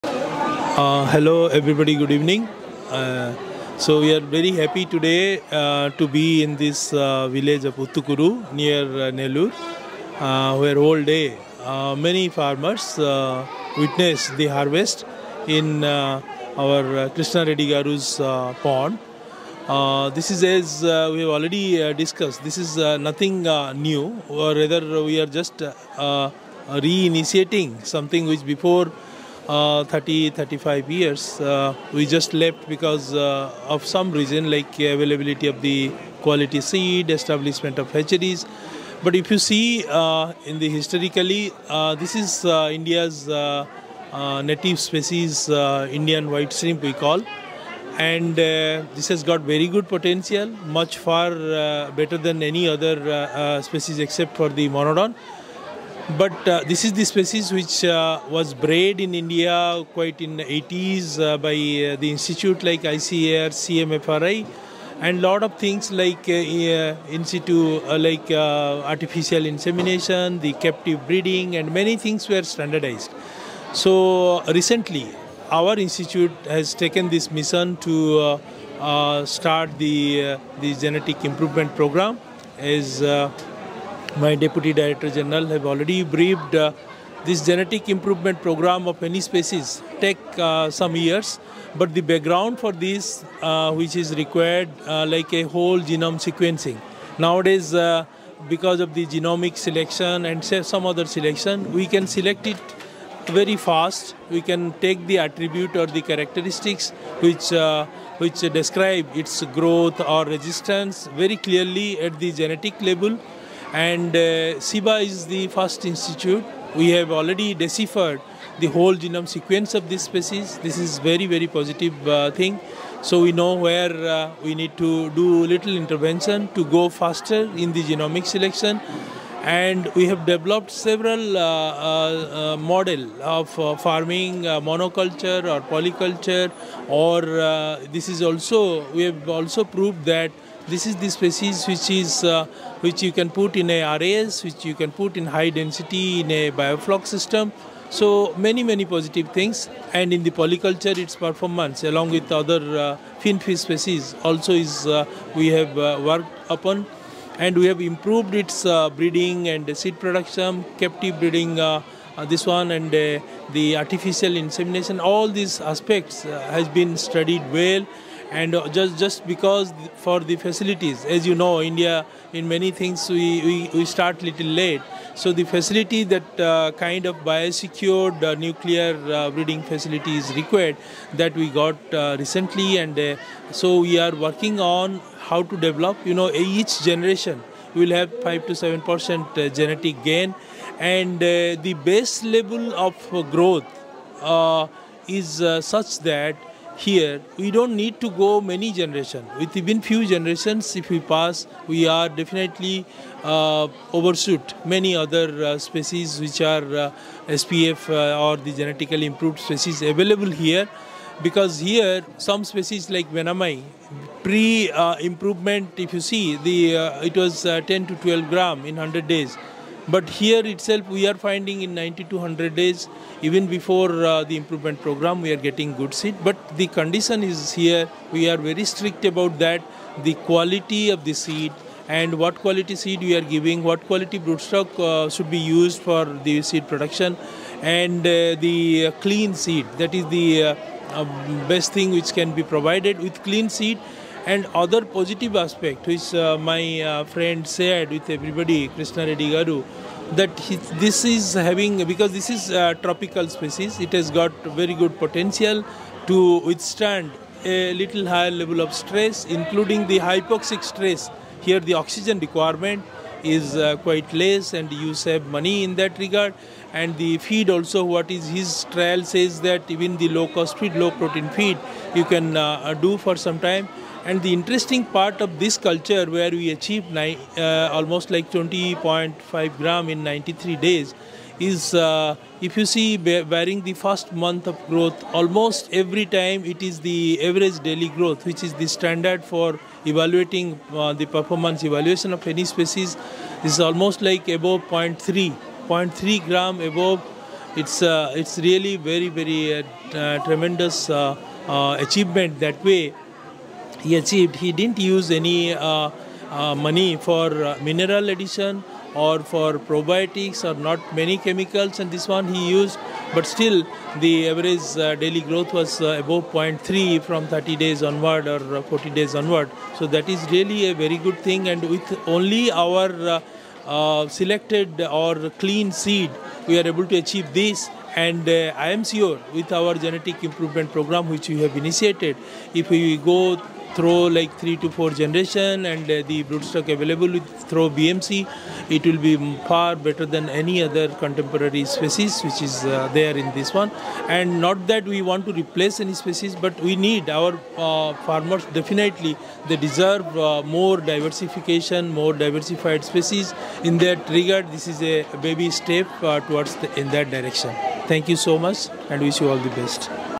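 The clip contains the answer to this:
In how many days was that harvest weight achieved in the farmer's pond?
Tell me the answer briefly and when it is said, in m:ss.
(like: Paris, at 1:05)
93 days, at 4:40.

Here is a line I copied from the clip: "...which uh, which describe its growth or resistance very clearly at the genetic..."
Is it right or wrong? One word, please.
right.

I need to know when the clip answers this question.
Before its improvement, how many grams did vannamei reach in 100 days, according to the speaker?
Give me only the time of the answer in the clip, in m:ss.
3:37.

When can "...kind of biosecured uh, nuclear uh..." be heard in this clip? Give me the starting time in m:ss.
2:56.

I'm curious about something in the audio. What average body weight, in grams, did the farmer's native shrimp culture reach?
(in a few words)
20.5 grams.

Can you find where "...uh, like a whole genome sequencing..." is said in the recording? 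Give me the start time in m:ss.
1:34.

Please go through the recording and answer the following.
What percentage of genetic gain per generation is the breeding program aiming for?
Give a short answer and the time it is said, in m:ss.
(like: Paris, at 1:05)
5 to 7 percent, at 3:08.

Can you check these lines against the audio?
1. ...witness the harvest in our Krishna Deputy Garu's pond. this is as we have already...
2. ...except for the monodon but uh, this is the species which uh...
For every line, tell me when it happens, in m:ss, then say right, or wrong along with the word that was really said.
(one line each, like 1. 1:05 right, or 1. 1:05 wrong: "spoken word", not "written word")
1. 0:13 wrong: "Reddy", not "Deputy"
2. 0:53 right.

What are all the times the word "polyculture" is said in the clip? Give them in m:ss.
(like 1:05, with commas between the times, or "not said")
2:15, 2:30.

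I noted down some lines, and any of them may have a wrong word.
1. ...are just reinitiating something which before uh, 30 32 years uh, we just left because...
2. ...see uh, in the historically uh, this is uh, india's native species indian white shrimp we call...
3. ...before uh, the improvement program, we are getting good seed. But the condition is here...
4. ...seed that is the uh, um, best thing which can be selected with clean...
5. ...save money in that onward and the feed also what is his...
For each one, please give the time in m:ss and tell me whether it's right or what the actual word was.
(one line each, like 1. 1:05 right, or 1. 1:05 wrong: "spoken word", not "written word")
1. 0:25 wrong: "35", not "32"
2. 0:39 right
3. 3:43 right
4. 3:59 wrong: "provided", not "selected"
5. 4:24 wrong: "regard", not "onward".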